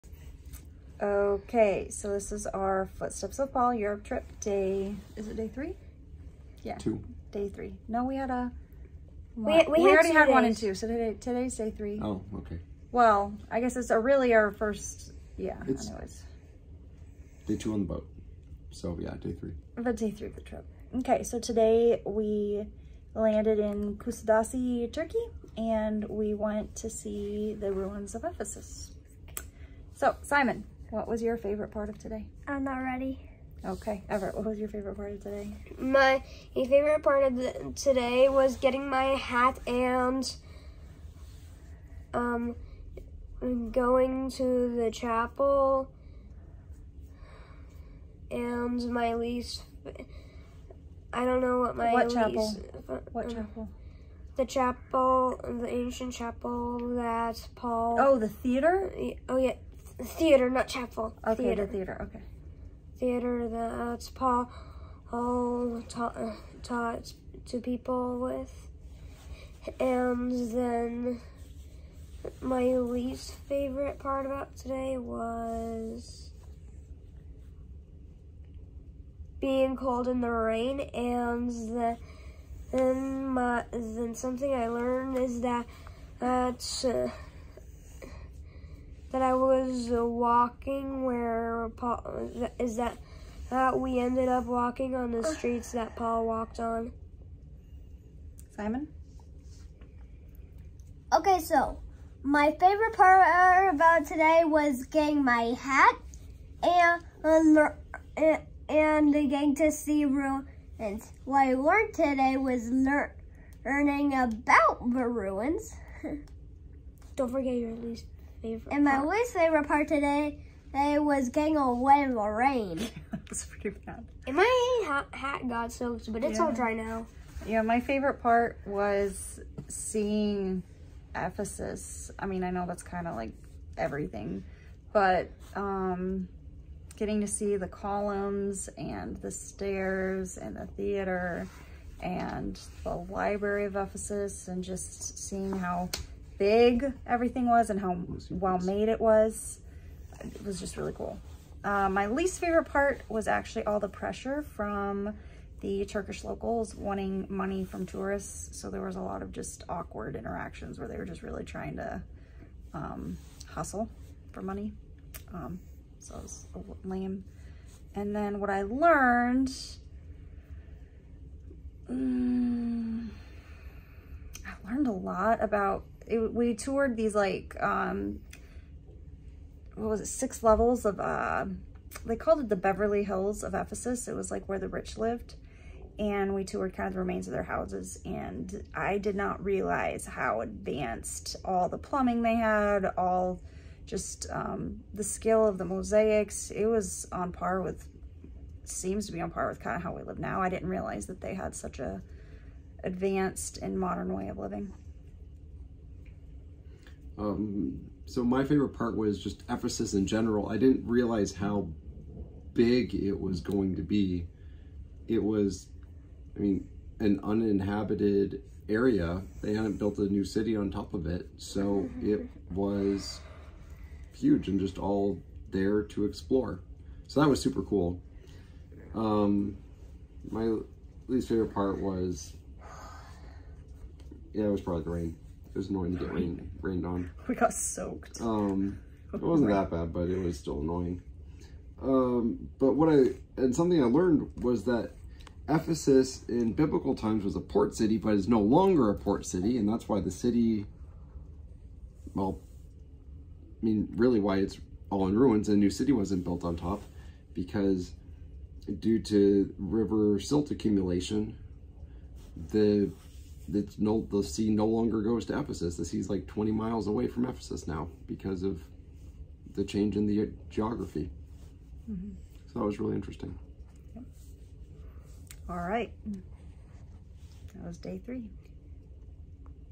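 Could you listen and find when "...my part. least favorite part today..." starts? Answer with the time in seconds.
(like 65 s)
118 s.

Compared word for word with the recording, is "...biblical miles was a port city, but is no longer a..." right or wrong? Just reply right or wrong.
wrong.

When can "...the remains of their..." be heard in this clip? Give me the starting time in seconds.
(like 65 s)
186 s.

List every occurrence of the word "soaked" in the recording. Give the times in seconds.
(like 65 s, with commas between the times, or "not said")
125 s, 237 s.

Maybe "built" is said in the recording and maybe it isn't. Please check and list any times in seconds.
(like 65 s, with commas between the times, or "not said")
219 s, 256 s.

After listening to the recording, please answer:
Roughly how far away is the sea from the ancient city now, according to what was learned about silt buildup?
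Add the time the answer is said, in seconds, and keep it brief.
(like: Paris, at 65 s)
20 miles, at 266 s.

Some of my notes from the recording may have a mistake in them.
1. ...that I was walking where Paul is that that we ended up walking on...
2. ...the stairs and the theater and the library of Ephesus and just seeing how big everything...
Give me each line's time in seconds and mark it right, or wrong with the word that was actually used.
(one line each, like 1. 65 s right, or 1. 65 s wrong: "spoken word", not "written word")
1. 89 s right
2. 139 s right.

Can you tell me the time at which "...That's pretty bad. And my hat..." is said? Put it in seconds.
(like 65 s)
123 s.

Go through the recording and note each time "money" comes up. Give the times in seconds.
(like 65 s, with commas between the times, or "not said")
157 s, 164 s.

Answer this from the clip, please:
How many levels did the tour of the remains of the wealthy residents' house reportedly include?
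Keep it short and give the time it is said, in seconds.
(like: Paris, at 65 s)
6, at 180 s.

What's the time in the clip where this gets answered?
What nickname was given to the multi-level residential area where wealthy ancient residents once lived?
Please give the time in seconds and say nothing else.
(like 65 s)
182 s.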